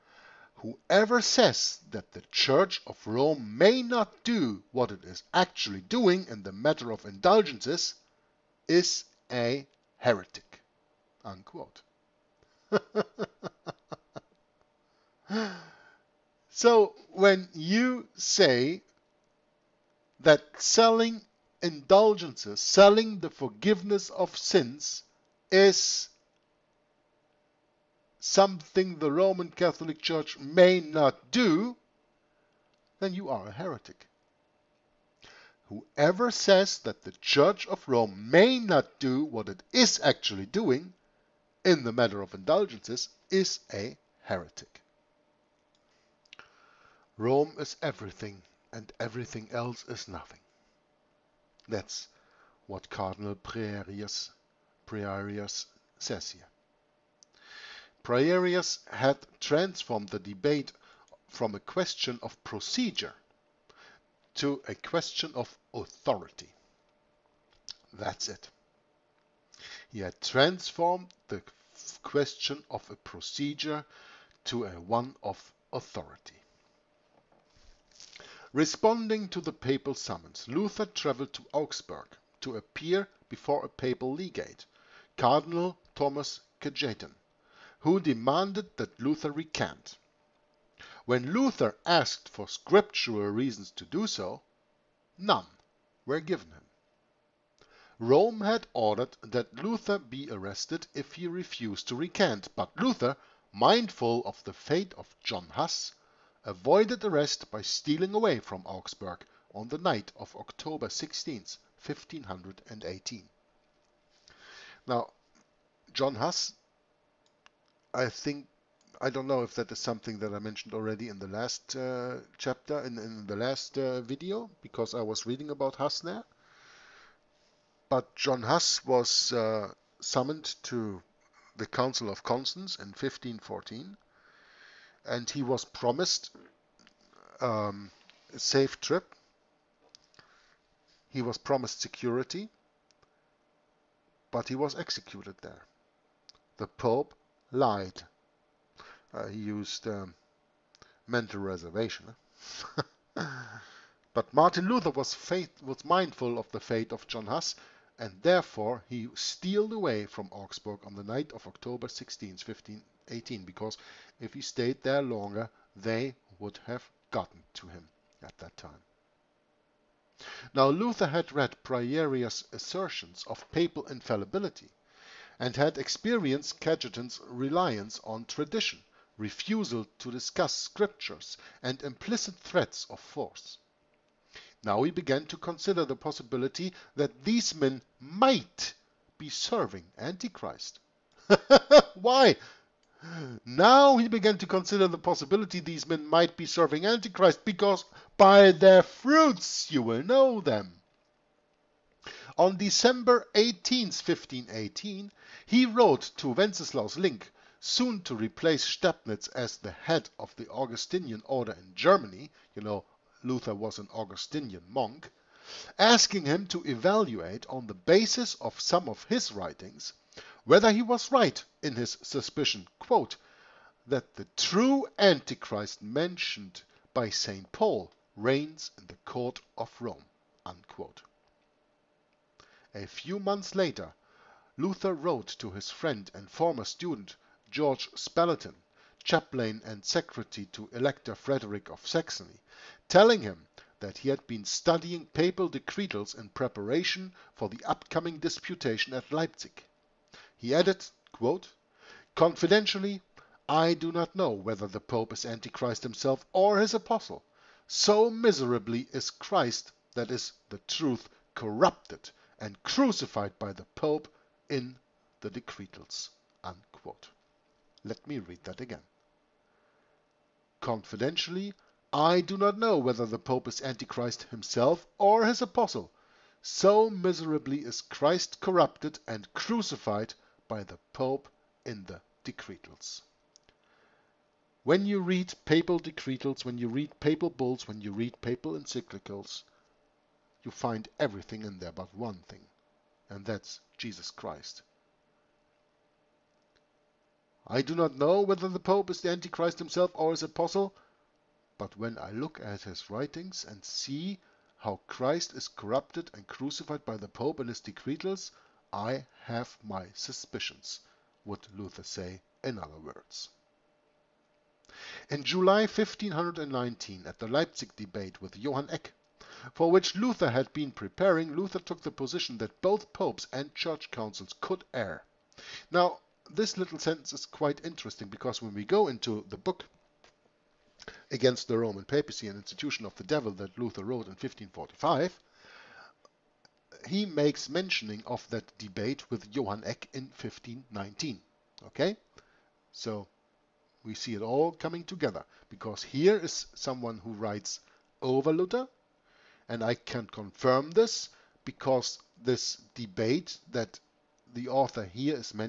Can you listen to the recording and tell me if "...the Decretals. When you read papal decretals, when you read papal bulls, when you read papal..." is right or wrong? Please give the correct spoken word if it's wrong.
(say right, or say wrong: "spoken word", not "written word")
right.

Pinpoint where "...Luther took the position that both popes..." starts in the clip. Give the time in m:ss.
5:21.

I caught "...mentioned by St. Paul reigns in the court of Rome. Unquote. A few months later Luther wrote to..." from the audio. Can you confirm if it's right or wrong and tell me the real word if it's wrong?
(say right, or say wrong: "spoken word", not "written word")
right.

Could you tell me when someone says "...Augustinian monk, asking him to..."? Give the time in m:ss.
3:33.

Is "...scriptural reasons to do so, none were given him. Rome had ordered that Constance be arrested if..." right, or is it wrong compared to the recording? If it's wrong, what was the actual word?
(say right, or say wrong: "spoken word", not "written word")
wrong: "Luther", not "Constance".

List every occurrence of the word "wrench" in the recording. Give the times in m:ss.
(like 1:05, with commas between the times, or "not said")
not said.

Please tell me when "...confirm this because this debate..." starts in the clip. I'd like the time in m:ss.
5:50.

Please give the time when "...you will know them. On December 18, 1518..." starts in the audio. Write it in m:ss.
3:19.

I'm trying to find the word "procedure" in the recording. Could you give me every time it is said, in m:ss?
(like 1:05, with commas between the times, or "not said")
1:02, 1:12.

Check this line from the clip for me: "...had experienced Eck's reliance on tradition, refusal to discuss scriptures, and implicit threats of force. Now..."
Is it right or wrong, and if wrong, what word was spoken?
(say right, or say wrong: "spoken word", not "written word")
wrong: "Cajetan", not "Eck".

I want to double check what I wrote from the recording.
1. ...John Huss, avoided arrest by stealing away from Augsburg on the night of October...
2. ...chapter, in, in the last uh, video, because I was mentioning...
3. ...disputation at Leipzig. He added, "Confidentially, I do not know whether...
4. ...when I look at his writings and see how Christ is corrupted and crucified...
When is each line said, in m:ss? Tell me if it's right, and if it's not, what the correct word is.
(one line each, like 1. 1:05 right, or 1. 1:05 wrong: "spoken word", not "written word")
1. 1:45 right
2. 2:02 wrong: "reading", not "mentioning"
3. 4:08 right
4. 5:01 right.